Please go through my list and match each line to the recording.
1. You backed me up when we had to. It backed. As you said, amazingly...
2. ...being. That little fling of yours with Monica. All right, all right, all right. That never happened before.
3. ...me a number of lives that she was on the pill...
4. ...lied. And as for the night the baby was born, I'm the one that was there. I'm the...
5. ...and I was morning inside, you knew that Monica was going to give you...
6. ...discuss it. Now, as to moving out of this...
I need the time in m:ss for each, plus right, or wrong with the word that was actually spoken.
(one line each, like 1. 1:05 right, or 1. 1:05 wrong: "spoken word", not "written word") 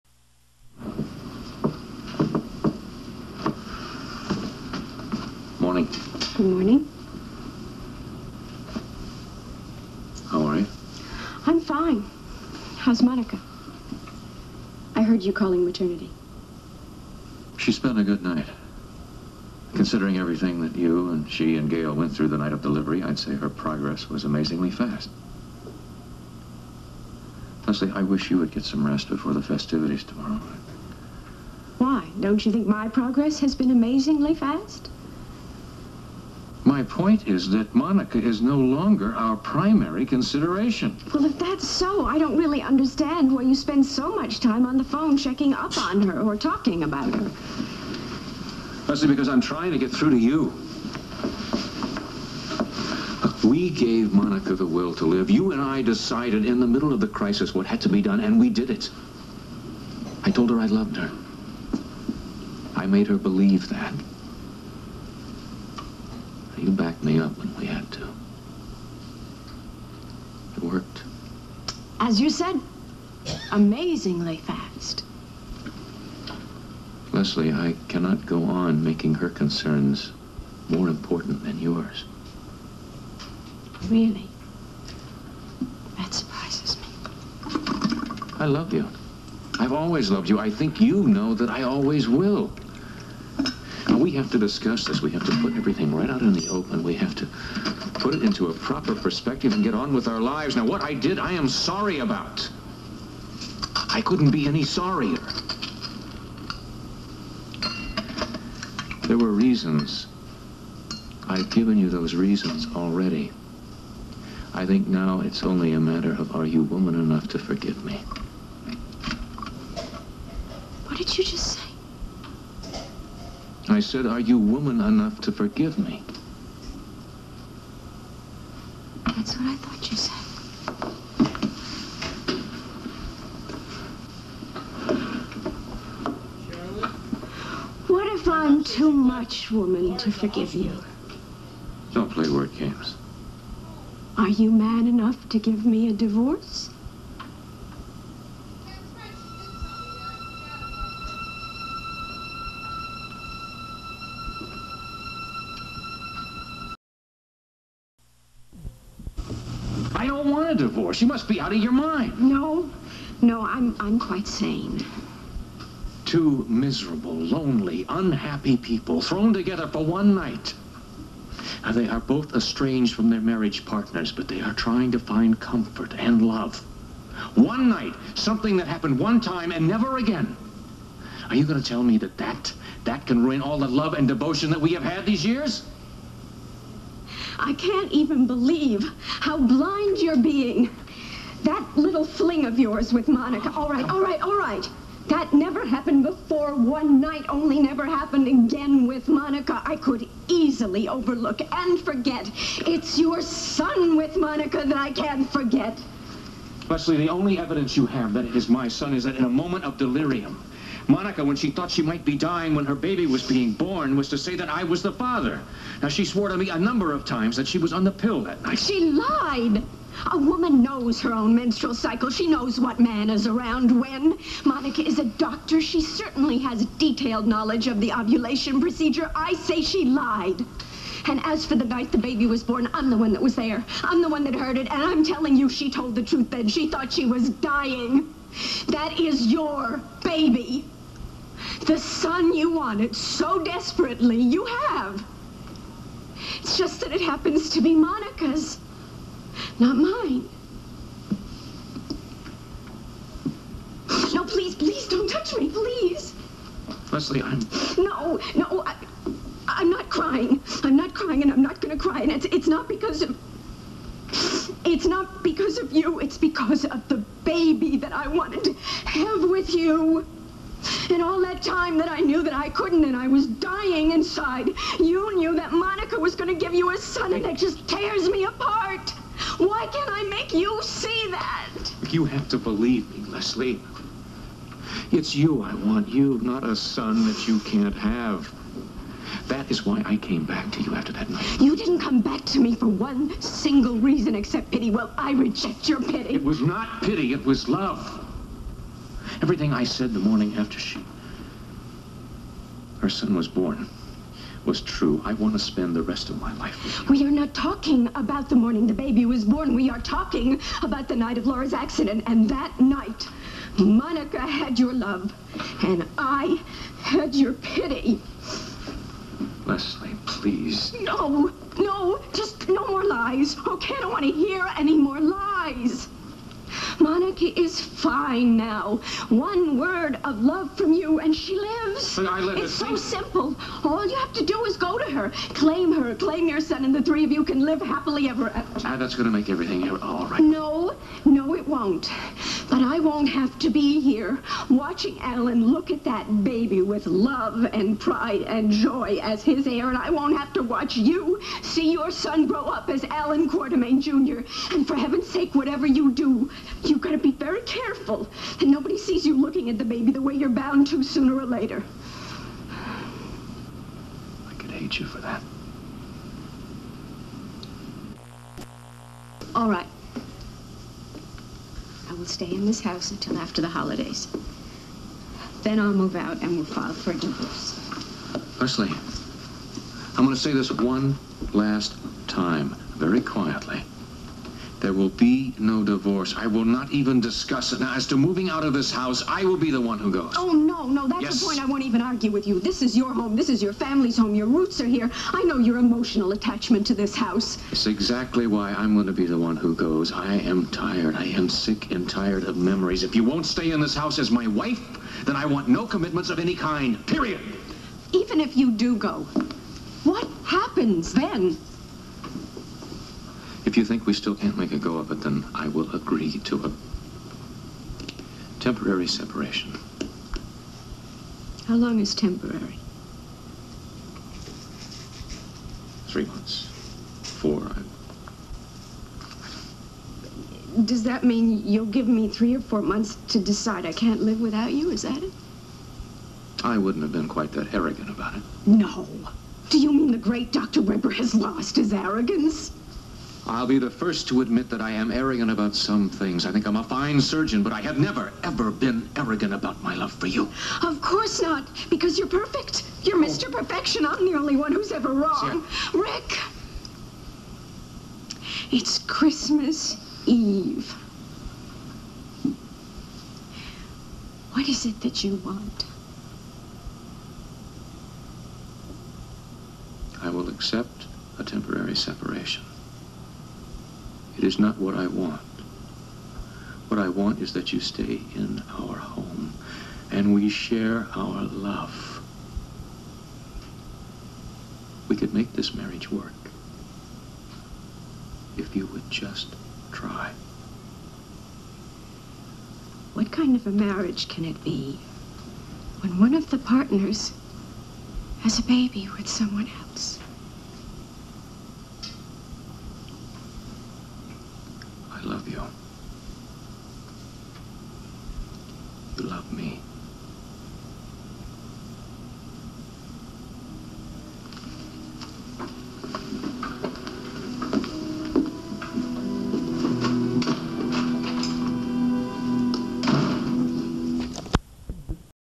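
1. 1:06 wrong: "worked", not "backed"
2. 3:10 right
3. 3:36 wrong: "times", not "lives"
4. 3:49 right
5. 4:32 wrong: "dying", not "morning"
6. 6:27 right.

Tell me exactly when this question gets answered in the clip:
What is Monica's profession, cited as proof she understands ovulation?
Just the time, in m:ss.
3:45.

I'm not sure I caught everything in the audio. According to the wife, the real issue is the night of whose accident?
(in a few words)
Laura.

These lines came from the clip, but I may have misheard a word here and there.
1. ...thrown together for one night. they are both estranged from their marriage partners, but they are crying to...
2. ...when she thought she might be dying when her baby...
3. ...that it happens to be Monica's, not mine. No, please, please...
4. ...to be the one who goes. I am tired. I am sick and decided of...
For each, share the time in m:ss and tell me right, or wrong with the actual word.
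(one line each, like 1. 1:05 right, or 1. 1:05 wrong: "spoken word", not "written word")
1. 2:49 wrong: "trying", not "crying"
2. 3:31 right
3. 4:06 right
4. 6:38 wrong: "tired", not "decided".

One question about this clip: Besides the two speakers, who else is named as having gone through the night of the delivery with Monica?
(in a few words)
Gail.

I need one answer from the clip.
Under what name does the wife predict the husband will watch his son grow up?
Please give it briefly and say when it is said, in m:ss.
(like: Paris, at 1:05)
Alan Quartermaine Jr., at 5:52.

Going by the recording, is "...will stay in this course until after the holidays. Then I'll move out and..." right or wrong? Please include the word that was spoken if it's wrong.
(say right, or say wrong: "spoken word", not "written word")
wrong: "house", not "course".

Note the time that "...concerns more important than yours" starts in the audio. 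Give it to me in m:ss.
1:19.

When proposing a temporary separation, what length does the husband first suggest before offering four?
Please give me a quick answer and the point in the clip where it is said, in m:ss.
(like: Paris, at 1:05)
3 months, at 7:05.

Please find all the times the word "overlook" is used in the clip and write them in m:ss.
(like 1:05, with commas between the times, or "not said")
3:20.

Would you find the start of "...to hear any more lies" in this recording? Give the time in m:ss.
5:24.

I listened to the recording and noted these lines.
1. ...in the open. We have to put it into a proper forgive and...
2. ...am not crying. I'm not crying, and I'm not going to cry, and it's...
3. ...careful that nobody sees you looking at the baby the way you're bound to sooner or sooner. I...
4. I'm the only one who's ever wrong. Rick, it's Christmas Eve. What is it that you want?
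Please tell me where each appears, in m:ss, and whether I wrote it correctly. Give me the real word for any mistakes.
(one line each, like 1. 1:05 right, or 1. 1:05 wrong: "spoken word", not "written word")
1. 1:36 wrong: "perspective", not "forgive"
2. 4:19 right
3. 5:57 wrong: "later", not "sooner"
4. 7:33 right.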